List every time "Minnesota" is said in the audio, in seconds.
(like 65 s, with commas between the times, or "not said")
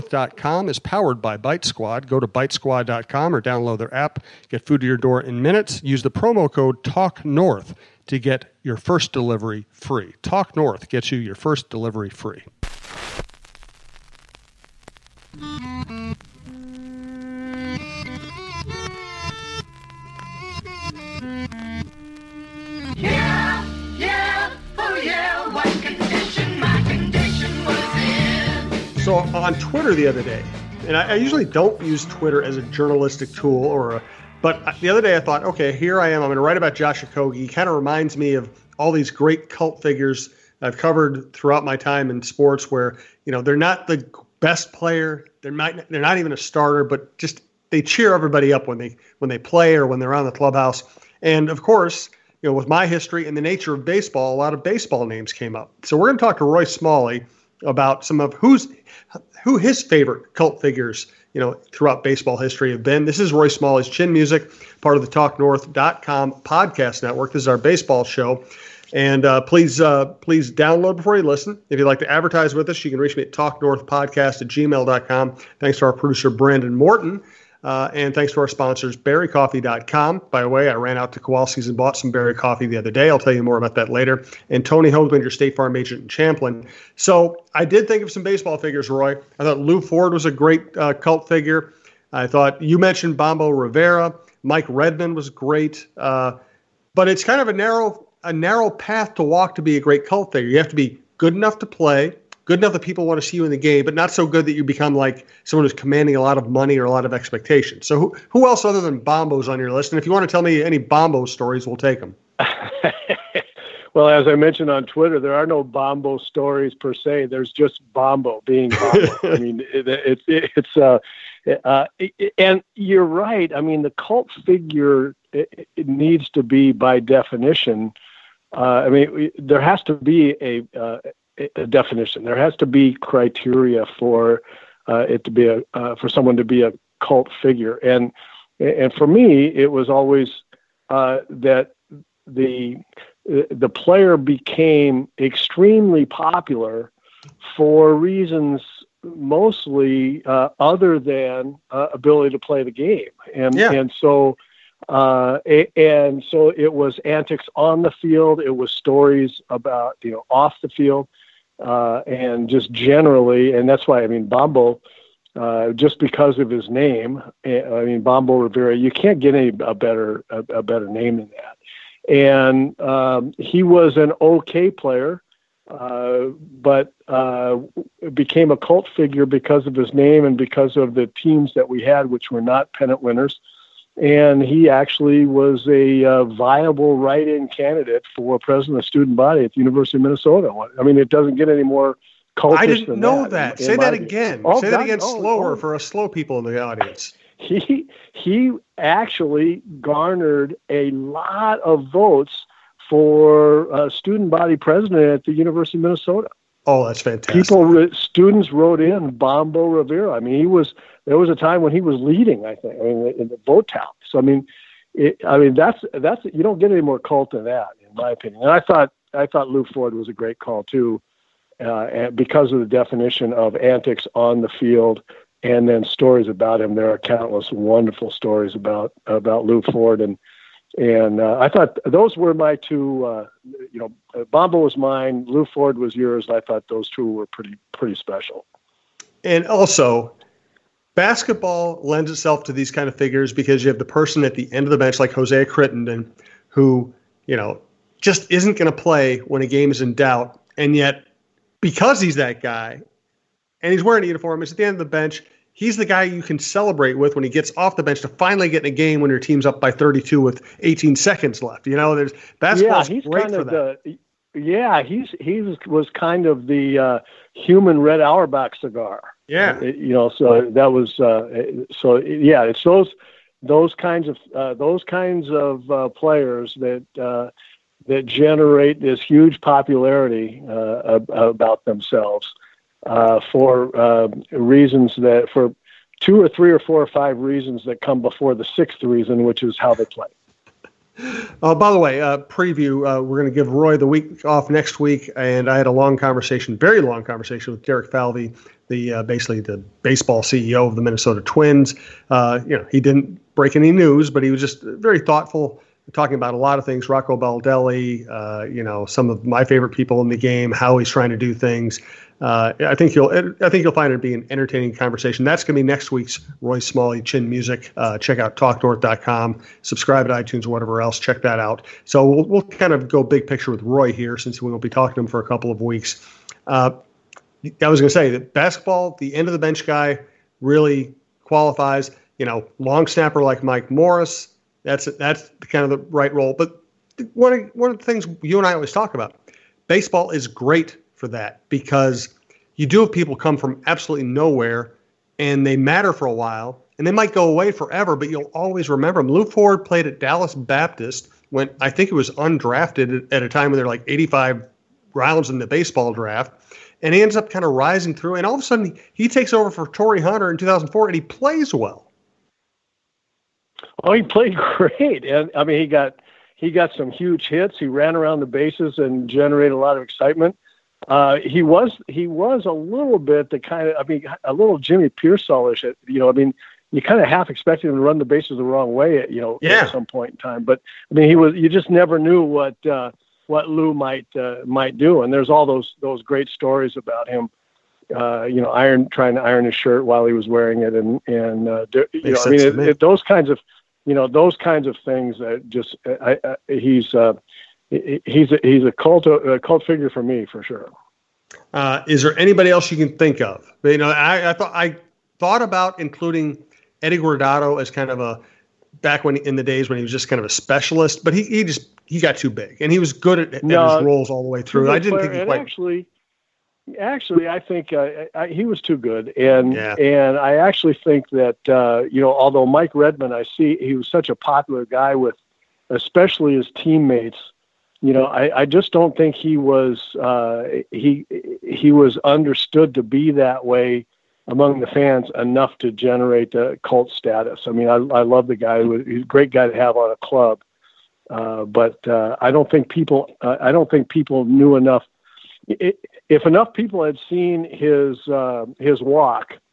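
190 s, 205 s, 300 s.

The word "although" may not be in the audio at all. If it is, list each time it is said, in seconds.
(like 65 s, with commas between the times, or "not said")
422 s.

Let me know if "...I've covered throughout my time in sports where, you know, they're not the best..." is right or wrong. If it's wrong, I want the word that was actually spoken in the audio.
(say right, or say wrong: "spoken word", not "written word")
right.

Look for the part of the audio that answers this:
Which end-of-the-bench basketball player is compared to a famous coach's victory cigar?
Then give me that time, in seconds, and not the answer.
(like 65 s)
245 s.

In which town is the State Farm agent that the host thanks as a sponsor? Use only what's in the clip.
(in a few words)
Champlin.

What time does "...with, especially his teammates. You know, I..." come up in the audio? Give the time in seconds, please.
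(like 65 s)
424 s.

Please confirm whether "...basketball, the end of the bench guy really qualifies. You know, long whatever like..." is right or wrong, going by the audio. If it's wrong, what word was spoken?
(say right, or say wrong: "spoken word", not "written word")
wrong: "snapper", not "whatever".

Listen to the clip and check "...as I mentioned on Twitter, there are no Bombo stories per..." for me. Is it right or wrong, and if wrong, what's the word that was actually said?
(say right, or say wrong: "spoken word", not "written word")
right.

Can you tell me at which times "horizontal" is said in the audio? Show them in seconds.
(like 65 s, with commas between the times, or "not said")
not said.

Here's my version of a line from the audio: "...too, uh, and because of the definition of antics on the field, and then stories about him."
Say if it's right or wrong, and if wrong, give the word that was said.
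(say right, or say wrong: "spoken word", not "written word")
right.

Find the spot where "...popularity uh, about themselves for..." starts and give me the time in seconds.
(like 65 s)
279 s.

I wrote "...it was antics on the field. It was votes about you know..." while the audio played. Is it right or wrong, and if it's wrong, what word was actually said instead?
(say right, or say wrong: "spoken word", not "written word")
wrong: "stories", not "votes".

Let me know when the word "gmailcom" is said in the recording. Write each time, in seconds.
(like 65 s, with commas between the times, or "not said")
74 s.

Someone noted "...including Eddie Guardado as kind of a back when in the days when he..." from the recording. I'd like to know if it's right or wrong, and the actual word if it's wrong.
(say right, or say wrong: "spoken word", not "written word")
right.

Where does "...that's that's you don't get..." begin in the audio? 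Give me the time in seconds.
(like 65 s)
215 s.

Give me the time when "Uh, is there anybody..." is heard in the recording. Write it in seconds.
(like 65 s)
401 s.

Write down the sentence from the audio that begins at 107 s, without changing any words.
So who, who else other than Bombo's on your list?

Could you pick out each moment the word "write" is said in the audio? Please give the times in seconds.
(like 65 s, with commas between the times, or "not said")
36 s, 186 s.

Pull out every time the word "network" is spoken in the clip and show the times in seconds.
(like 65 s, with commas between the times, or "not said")
67 s.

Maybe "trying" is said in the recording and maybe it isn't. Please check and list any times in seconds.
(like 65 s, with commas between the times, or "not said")
310 s, 388 s.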